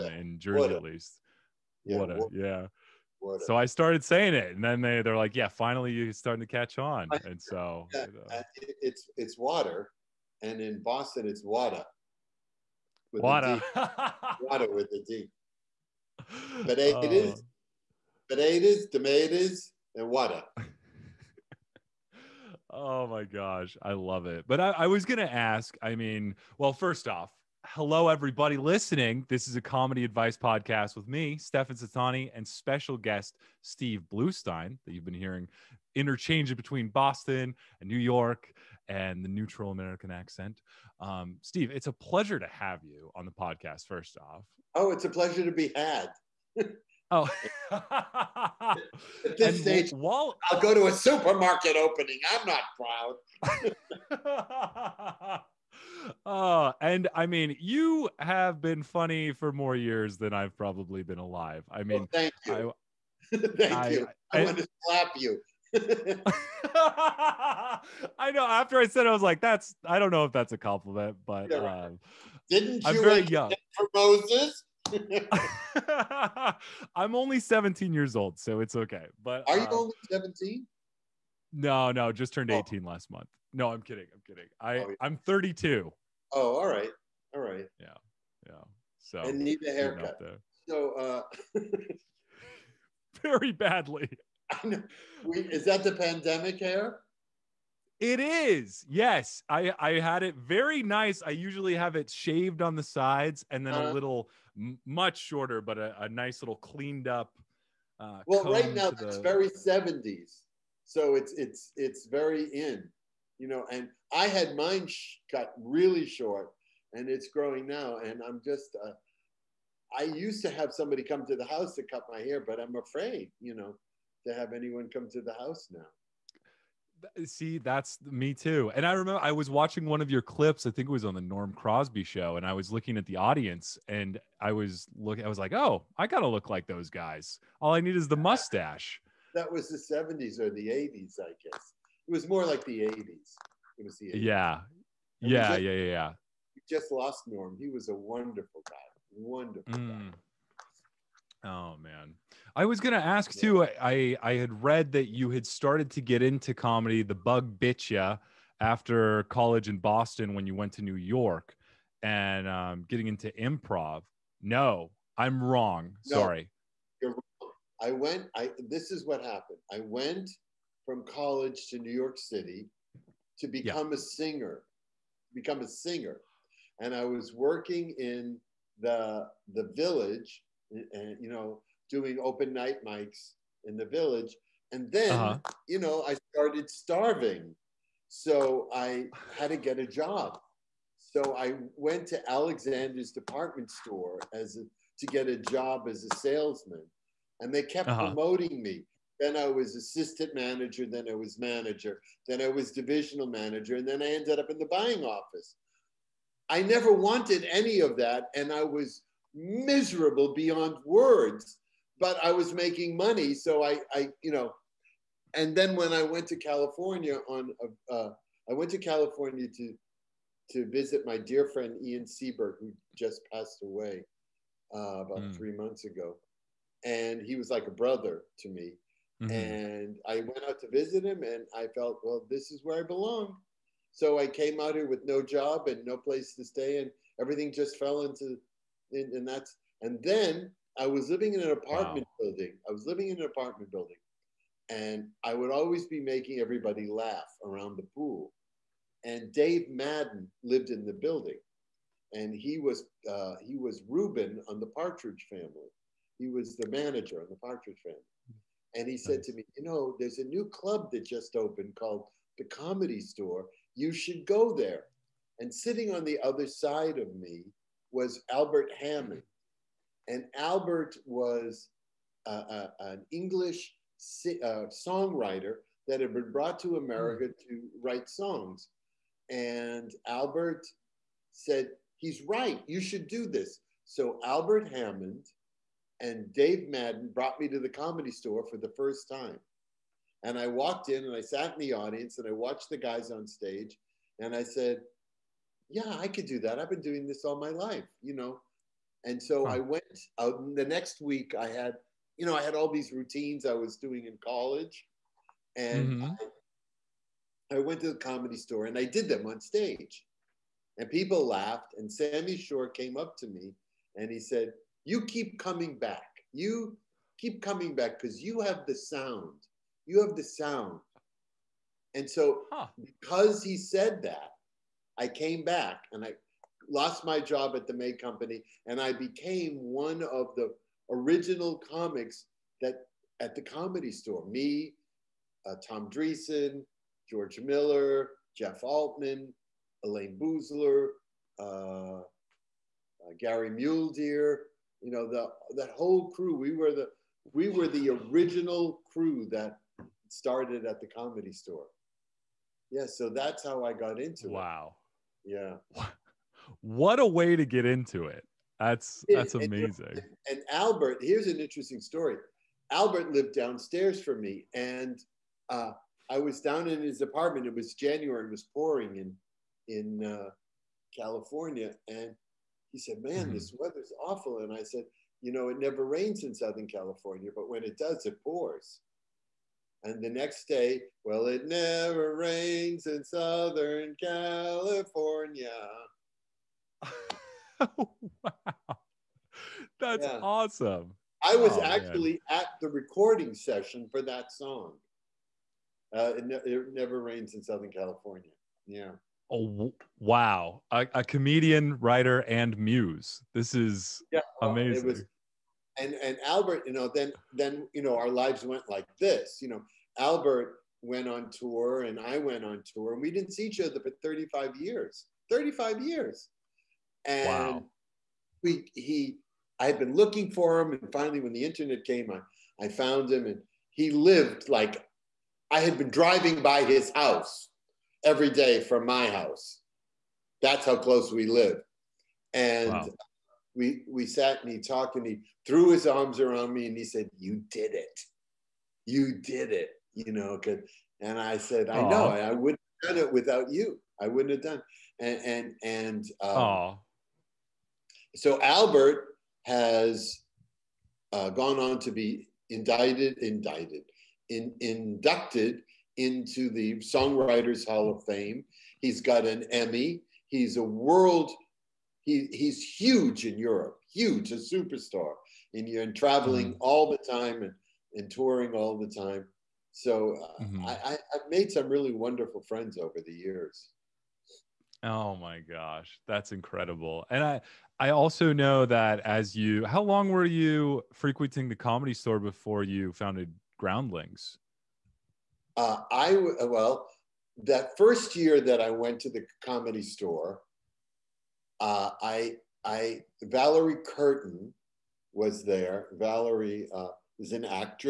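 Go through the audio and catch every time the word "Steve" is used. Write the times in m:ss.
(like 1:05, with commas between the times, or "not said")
0:33, 0:41.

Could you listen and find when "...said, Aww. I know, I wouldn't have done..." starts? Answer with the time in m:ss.
7:21.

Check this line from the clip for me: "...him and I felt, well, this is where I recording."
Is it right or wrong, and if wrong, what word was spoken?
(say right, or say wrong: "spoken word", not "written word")
wrong: "belong", not "recording".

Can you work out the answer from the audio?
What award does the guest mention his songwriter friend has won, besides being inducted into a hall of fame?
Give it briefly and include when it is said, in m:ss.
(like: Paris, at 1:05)
Emmy, at 7:39.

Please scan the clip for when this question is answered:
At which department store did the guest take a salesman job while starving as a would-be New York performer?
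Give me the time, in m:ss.
3:12.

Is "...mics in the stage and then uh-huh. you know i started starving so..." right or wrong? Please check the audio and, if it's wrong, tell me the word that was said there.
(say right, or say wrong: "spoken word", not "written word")
wrong: "village", not "stage".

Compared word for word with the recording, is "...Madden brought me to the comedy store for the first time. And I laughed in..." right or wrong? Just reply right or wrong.
wrong.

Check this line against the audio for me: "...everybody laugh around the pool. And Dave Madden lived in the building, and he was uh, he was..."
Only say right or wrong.
right.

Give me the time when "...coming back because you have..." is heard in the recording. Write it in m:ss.
5:17.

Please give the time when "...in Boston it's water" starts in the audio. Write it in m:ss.
0:10.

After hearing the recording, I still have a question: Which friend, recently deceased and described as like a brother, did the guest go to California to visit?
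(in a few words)
Ian Seberg.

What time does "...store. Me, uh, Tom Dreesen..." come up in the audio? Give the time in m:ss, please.
5:33.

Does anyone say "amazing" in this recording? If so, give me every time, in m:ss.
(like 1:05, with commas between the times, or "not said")
5:59, 6:44.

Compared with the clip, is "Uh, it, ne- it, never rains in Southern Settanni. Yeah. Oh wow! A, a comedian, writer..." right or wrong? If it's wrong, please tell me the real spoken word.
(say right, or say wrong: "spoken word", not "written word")
wrong: "California", not "Settanni".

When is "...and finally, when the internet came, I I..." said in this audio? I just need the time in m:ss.
7:00.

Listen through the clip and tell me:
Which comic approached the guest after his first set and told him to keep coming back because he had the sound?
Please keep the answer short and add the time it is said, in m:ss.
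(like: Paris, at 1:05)
Sammy Shore, at 5:11.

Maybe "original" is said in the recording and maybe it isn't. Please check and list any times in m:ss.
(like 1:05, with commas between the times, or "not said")
5:30, 5:47.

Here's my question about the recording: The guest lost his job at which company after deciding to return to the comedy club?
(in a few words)
May Company.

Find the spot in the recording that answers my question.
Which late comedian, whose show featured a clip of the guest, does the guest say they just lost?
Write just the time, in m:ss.
2:11.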